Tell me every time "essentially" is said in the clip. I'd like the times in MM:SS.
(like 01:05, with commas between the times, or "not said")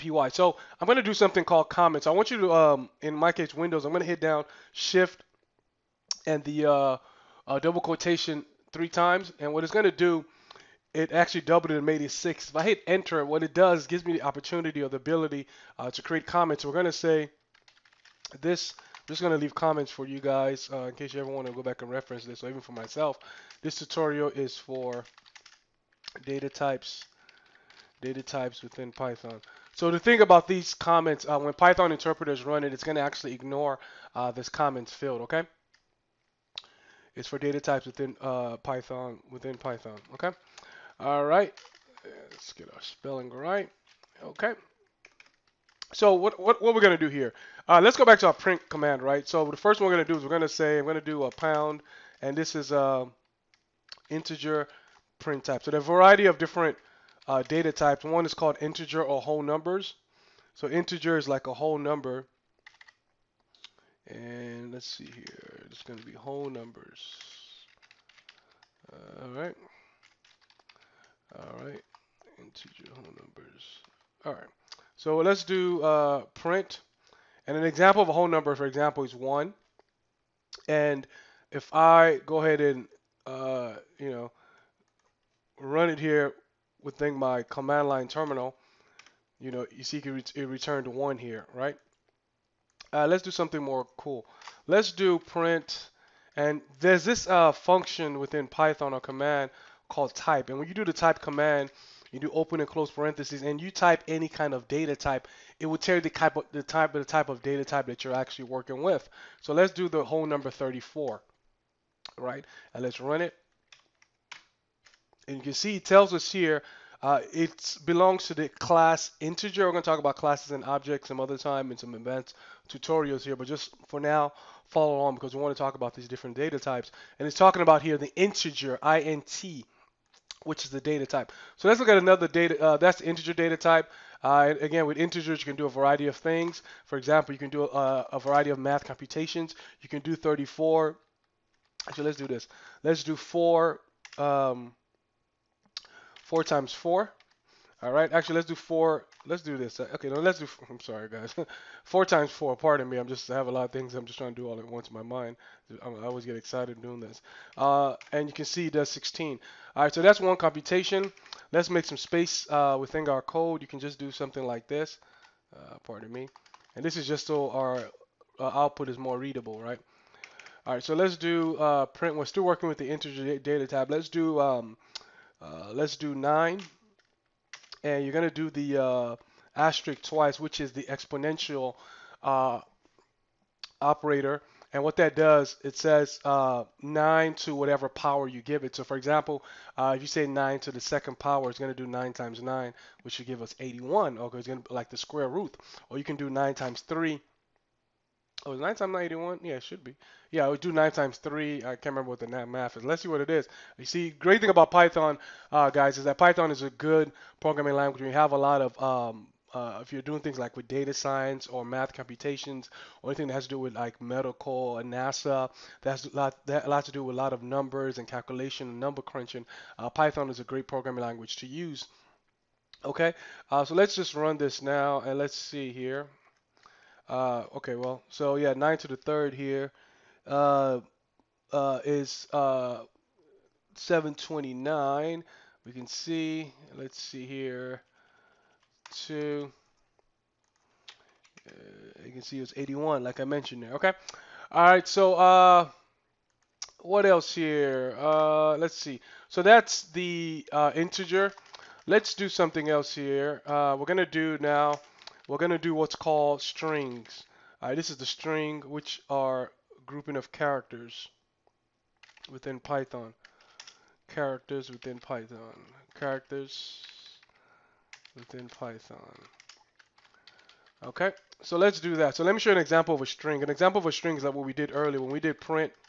not said.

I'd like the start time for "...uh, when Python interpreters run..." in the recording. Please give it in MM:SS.
00:31.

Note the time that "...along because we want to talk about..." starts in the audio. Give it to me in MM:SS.
02:04.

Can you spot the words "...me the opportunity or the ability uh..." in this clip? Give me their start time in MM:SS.
00:14.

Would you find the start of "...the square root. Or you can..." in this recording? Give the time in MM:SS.
03:14.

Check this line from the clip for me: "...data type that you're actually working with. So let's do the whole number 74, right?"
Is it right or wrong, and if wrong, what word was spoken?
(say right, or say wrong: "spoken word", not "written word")
wrong: "34", not "74".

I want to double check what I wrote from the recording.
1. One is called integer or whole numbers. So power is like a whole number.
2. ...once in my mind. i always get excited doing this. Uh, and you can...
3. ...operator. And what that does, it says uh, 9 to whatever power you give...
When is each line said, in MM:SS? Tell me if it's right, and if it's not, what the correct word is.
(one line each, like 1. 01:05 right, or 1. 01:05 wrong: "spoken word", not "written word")
1. 00:58 wrong: "integer", not "power"
2. 02:34 right
3. 03:03 right.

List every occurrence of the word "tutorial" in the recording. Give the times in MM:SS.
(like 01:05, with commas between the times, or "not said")
00:23, 02:02.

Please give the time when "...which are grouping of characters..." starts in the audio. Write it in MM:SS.
04:18.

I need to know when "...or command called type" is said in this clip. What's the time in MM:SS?
01:38.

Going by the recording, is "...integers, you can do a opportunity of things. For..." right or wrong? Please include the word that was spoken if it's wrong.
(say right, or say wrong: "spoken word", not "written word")
wrong: "variety", not "opportunity".